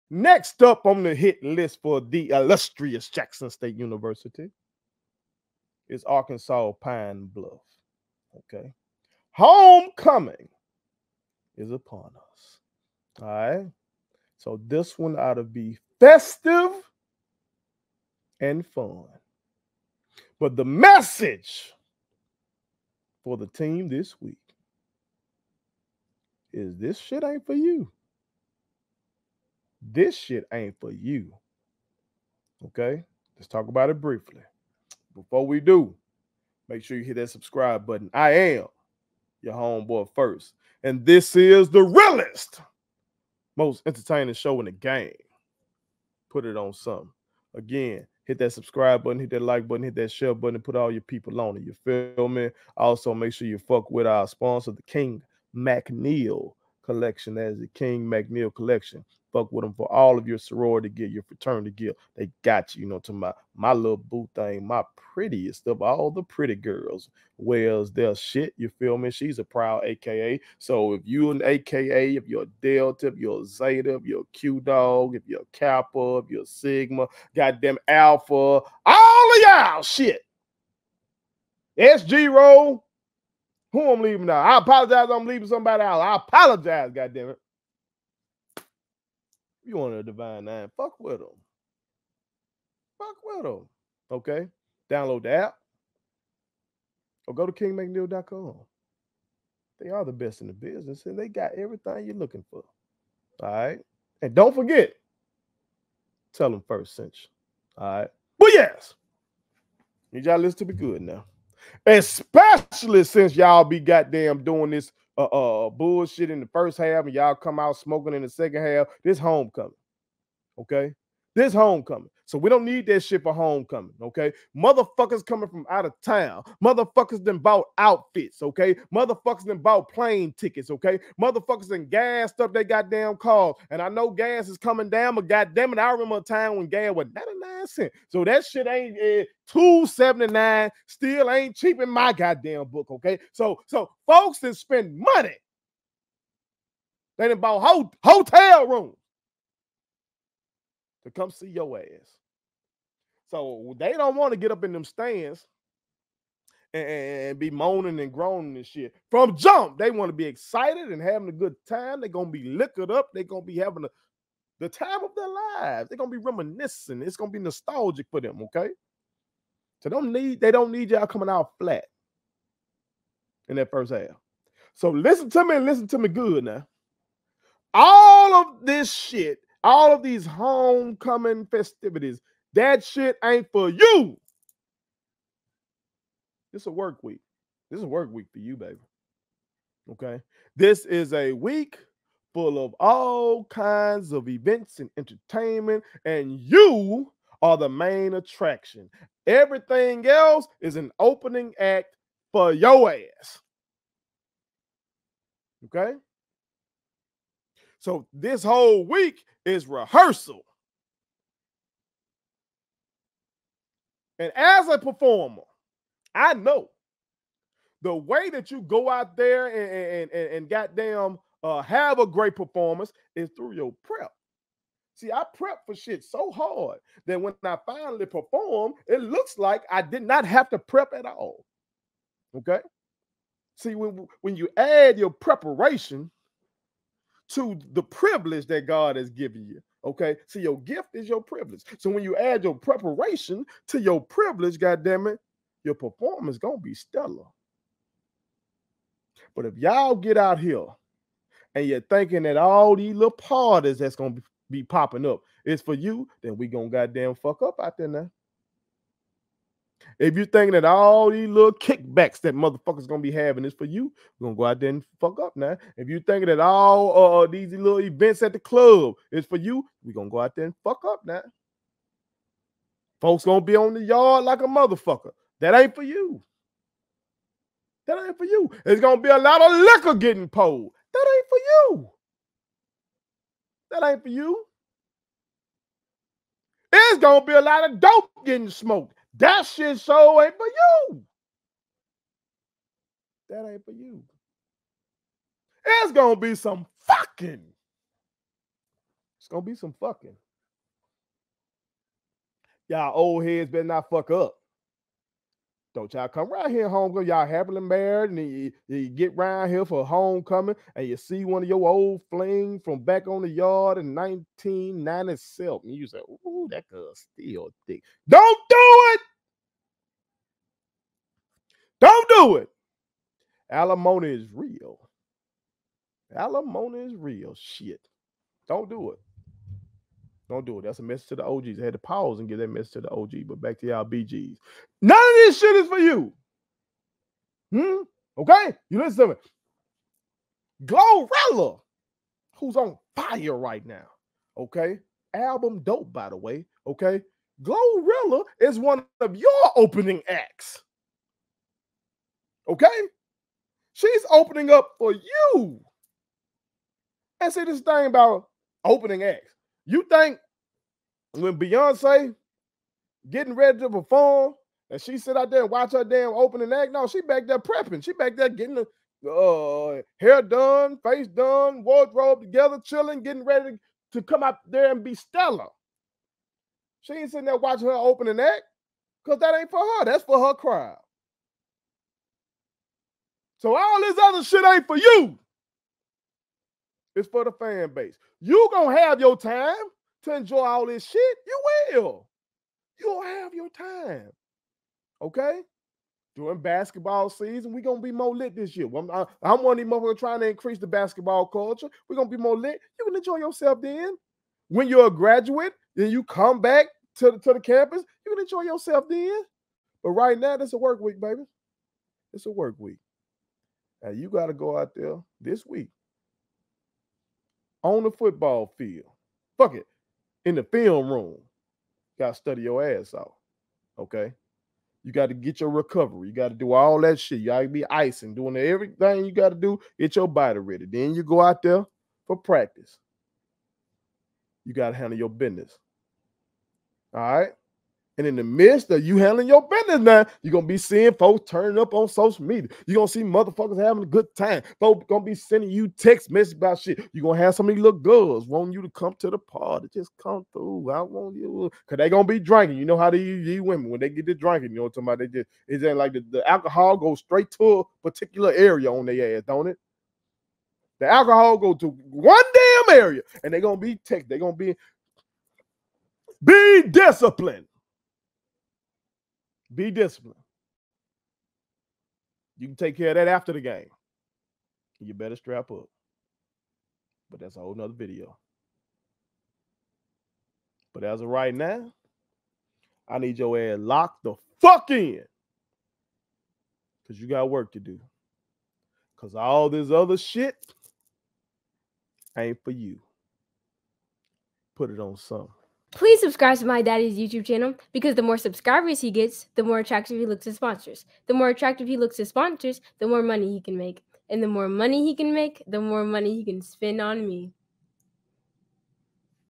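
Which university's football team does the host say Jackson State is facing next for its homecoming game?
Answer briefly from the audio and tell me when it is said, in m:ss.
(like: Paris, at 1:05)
Arkansas Pine Bluff, at 0:06.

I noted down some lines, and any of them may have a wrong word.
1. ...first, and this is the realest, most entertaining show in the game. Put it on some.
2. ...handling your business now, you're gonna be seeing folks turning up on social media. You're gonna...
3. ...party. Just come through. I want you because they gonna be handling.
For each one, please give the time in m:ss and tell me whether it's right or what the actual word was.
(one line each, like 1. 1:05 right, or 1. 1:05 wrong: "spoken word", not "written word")
1. 0:40 right
2. 7:18 right
3. 7:29 wrong: "drinking", not "handling".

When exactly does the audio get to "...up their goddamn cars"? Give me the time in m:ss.
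2:12.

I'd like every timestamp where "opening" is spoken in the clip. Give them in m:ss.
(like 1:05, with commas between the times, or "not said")
3:20, 5:49, 5:54, 5:58, 6:06, 6:17.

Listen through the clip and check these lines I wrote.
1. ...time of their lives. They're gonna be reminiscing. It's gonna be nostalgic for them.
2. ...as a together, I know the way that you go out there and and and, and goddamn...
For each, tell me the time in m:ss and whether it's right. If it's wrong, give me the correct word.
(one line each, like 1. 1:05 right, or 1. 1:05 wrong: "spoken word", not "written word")
1. 2:44 right
2. 3:34 wrong: "performer", not "together".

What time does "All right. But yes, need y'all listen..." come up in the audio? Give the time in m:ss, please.
1:47.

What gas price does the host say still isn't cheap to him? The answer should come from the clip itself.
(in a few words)
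279.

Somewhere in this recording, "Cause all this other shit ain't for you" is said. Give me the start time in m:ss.
8:08.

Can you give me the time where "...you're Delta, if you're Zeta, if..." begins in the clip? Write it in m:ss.
1:12.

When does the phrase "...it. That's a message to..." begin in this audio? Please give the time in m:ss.
5:30.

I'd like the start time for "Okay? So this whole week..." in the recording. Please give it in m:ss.
3:25.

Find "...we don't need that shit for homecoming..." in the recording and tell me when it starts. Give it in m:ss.
2:02.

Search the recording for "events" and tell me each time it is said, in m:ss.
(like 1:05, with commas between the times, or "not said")
3:14, 4:27.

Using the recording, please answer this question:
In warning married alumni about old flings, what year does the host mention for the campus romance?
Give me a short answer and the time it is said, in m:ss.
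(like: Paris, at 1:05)
1997, at 5:13.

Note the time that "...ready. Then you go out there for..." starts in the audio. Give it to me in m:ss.
7:10.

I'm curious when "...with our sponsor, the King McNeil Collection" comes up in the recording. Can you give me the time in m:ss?
0:53.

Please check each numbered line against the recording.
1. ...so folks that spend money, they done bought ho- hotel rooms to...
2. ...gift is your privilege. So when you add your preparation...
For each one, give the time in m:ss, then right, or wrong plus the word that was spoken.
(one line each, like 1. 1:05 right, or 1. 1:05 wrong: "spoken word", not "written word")
1. 2:23 right
2. 4:00 right.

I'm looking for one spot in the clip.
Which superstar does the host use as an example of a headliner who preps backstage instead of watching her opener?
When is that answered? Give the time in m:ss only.
6:01.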